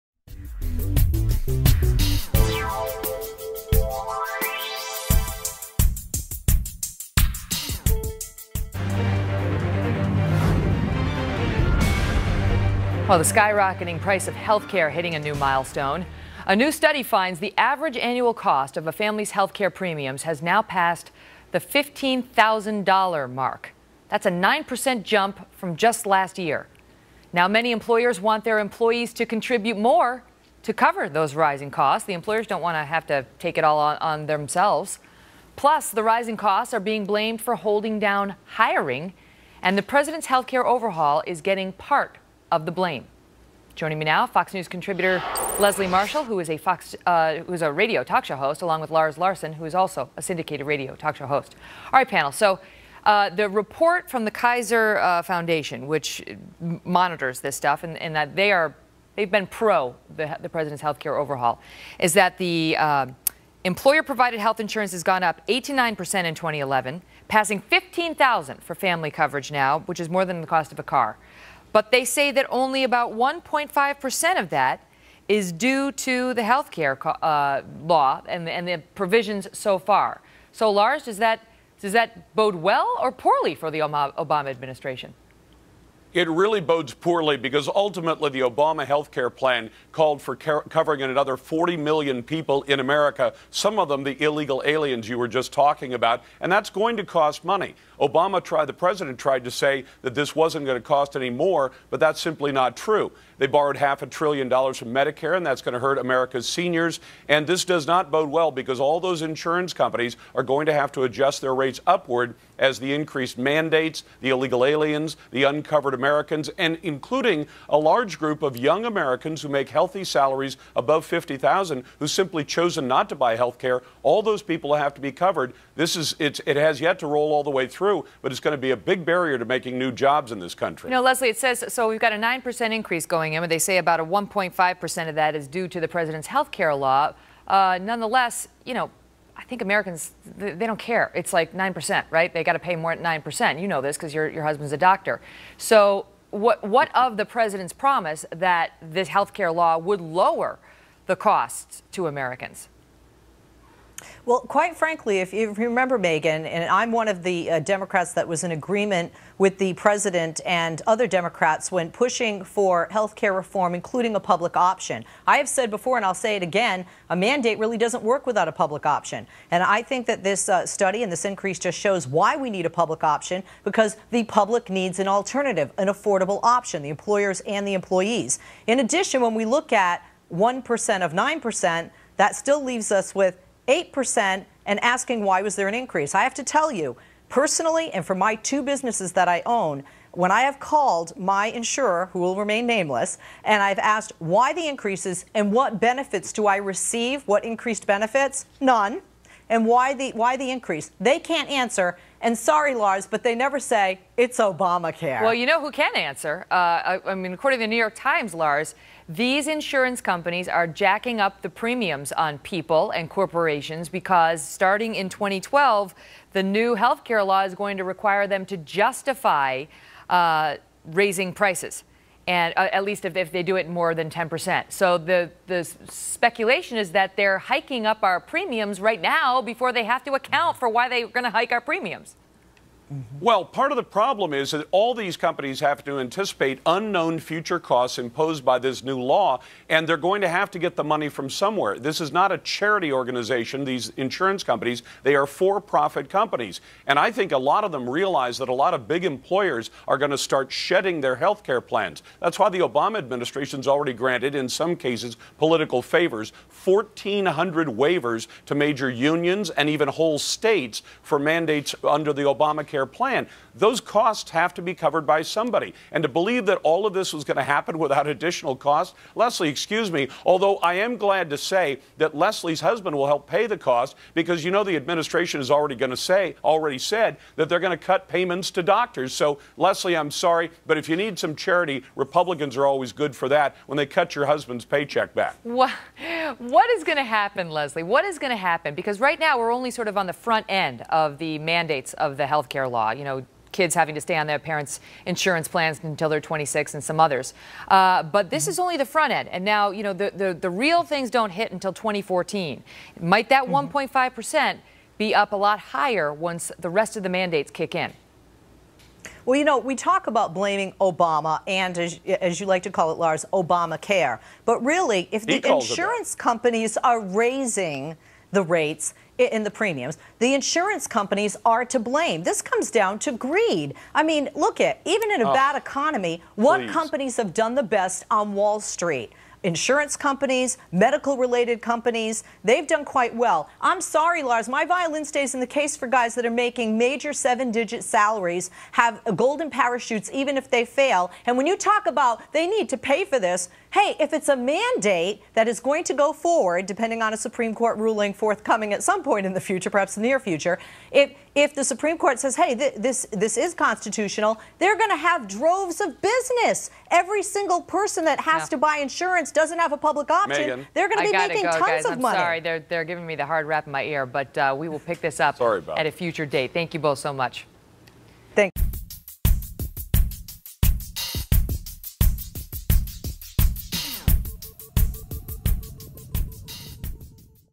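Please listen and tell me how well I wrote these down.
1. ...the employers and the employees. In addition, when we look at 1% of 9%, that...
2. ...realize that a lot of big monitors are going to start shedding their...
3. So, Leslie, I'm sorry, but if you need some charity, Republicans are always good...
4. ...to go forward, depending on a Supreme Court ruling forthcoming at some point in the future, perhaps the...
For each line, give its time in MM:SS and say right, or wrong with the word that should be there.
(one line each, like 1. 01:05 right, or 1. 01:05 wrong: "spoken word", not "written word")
1. 02:56 right
2. 04:07 wrong: "employers", not "monitors"
3. 04:39 right
4. 05:45 right.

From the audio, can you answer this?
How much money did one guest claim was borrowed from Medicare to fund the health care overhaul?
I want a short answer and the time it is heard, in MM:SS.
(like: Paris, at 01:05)
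half a trillion dollars, at 01:43.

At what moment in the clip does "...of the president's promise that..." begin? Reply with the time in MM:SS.
02:26.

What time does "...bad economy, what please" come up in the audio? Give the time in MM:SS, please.
05:25.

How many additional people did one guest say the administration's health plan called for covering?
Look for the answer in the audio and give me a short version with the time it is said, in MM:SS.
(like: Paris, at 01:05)
40 million, at 01:31.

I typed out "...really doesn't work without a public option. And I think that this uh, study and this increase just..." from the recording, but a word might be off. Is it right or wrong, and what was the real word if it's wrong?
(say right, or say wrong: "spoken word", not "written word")
right.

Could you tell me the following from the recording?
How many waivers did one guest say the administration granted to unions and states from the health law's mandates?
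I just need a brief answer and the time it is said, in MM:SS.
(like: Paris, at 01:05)
1,400, at 04:16.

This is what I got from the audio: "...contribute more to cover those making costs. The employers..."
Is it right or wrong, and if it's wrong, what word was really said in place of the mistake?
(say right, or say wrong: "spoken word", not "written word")
wrong: "rising", not "making".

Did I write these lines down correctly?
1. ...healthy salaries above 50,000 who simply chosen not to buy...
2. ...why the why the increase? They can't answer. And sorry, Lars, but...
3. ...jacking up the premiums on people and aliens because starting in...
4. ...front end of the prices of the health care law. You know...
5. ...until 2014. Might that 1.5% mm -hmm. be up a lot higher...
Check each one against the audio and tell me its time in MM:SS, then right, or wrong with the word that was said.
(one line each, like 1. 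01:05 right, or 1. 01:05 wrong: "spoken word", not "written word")
1. 01:59 right
2. 03:19 right
3. 03:30 wrong: "corporations", not "aliens"
4. 04:50 wrong: "mandates", not "prices"
5. 05:01 right.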